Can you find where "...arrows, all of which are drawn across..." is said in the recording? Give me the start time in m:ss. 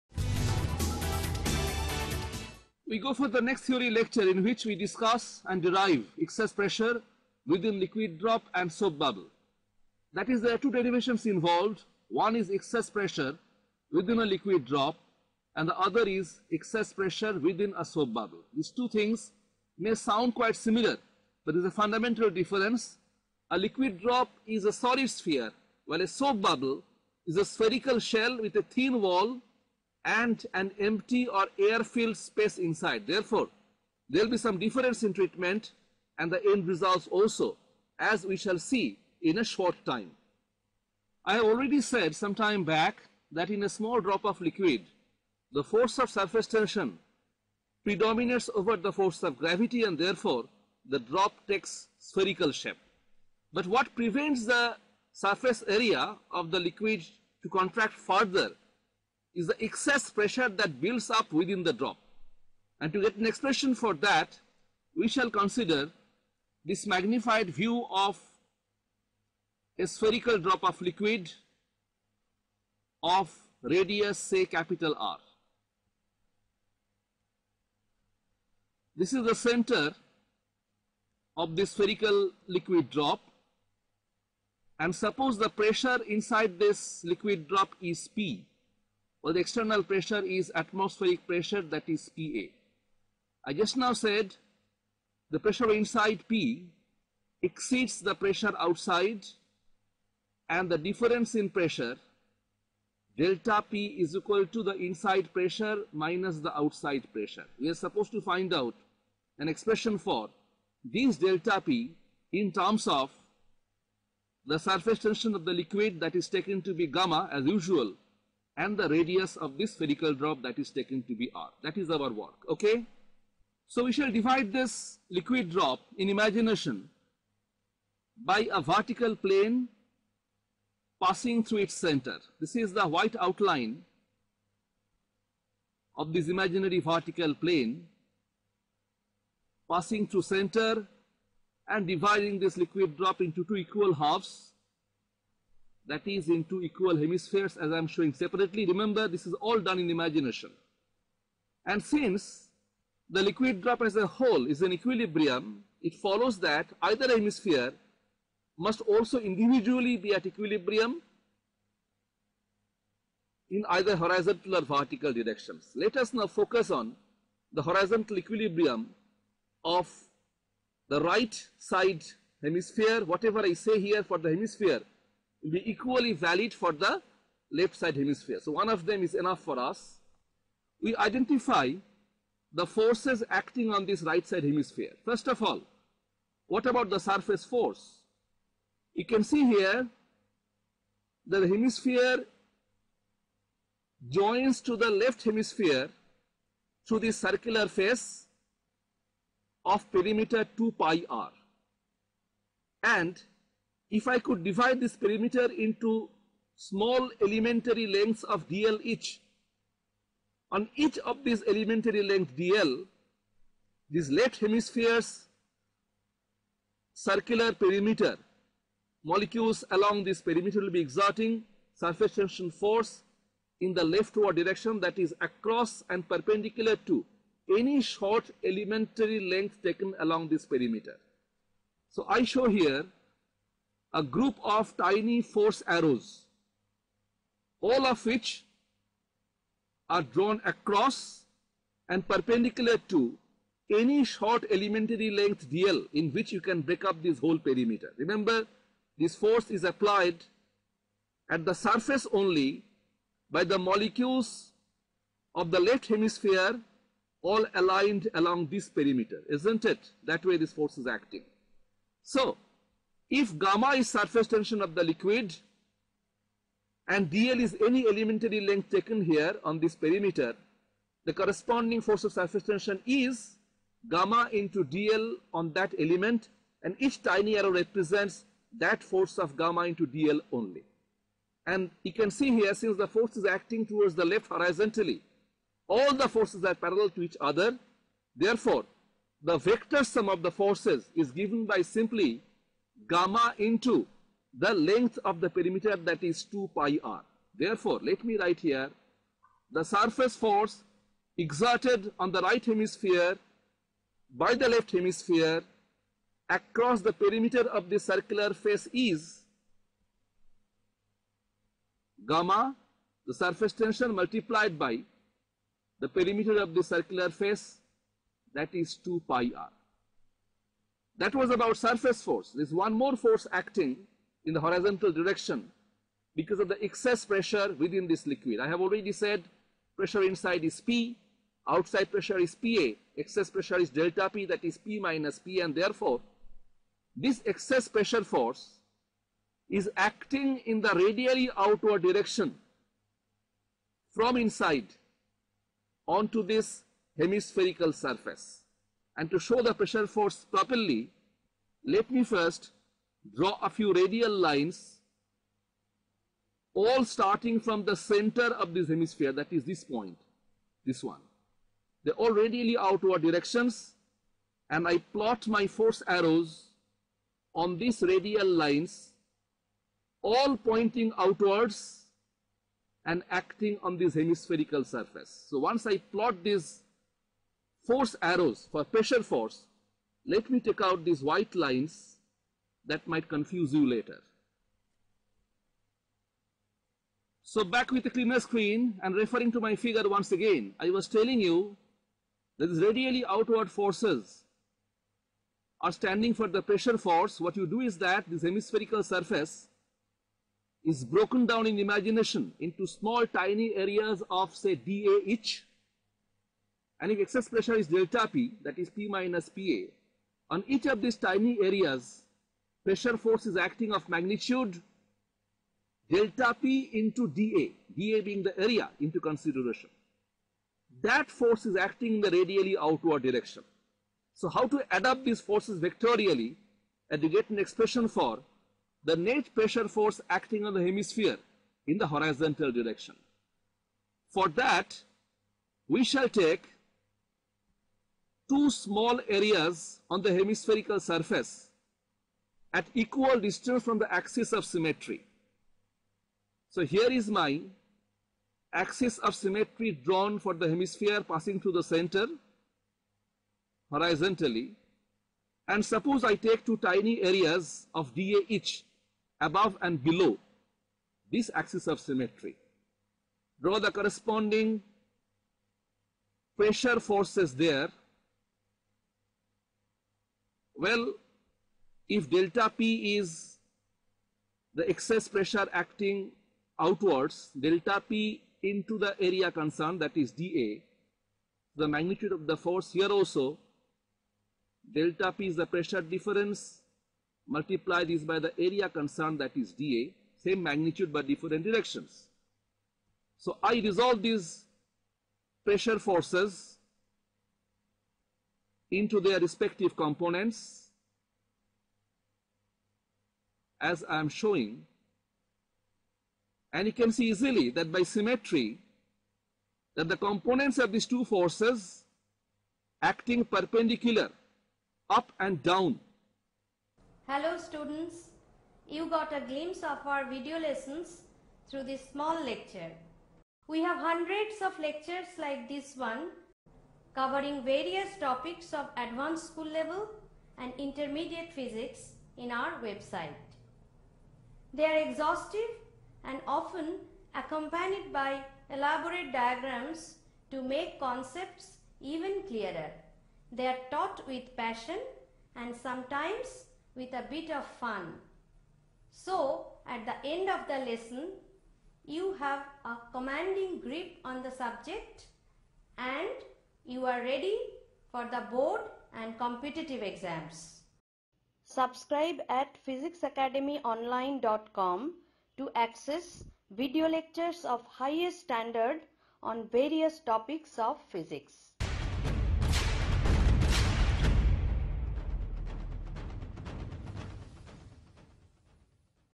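3:55.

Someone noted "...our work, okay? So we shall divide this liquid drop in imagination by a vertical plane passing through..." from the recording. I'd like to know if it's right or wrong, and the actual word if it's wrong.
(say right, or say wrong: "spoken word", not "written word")
right.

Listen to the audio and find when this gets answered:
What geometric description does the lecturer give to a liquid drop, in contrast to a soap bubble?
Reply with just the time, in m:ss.
0:24.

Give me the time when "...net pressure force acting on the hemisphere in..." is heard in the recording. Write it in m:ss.
7:08.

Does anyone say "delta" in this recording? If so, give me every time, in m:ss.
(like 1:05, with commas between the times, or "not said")
1:43, 1:51, 5:33, 6:47, 6:55, 7:52, 7:57, 8:04.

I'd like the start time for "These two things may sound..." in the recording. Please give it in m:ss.
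0:18.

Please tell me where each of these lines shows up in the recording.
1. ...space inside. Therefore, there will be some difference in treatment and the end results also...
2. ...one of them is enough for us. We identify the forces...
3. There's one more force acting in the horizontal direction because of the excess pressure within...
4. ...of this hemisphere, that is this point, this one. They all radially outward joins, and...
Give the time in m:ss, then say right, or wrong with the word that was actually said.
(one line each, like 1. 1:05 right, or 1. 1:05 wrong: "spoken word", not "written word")
1. 0:32 right
2. 2:58 right
3. 5:22 right
4. 5:58 wrong: "directions", not "joins".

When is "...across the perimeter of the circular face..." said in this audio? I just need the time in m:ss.
5:06.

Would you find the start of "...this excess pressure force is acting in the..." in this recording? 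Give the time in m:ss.
5:36.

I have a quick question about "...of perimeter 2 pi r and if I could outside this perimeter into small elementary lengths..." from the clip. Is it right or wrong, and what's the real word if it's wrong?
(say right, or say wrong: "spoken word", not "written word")
wrong: "divide", not "outside".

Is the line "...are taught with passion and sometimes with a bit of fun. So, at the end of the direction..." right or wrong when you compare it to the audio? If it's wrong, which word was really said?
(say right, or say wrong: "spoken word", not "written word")
wrong: "lesson", not "direction".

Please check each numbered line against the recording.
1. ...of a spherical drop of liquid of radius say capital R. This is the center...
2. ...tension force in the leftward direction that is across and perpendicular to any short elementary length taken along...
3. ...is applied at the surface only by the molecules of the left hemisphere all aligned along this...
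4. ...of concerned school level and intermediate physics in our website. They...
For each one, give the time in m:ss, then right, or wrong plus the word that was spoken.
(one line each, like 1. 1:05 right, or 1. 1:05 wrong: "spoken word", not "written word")
1. 1:07 right
2. 3:42 right
3. 4:09 right
4. 8:48 wrong: "advanced", not "concerned".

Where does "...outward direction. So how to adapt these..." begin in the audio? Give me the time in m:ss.
7:02.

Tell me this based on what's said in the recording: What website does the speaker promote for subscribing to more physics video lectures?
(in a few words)
physicsacademyonline.com.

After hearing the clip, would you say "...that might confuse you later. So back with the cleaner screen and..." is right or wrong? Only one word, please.
right.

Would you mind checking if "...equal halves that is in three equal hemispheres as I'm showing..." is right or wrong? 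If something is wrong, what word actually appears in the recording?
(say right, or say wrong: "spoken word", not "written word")
wrong: "two", not "three".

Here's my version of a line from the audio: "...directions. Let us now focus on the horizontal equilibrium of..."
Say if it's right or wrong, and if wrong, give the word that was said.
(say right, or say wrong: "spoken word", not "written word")
right.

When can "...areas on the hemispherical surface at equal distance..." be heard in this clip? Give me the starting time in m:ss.
7:19.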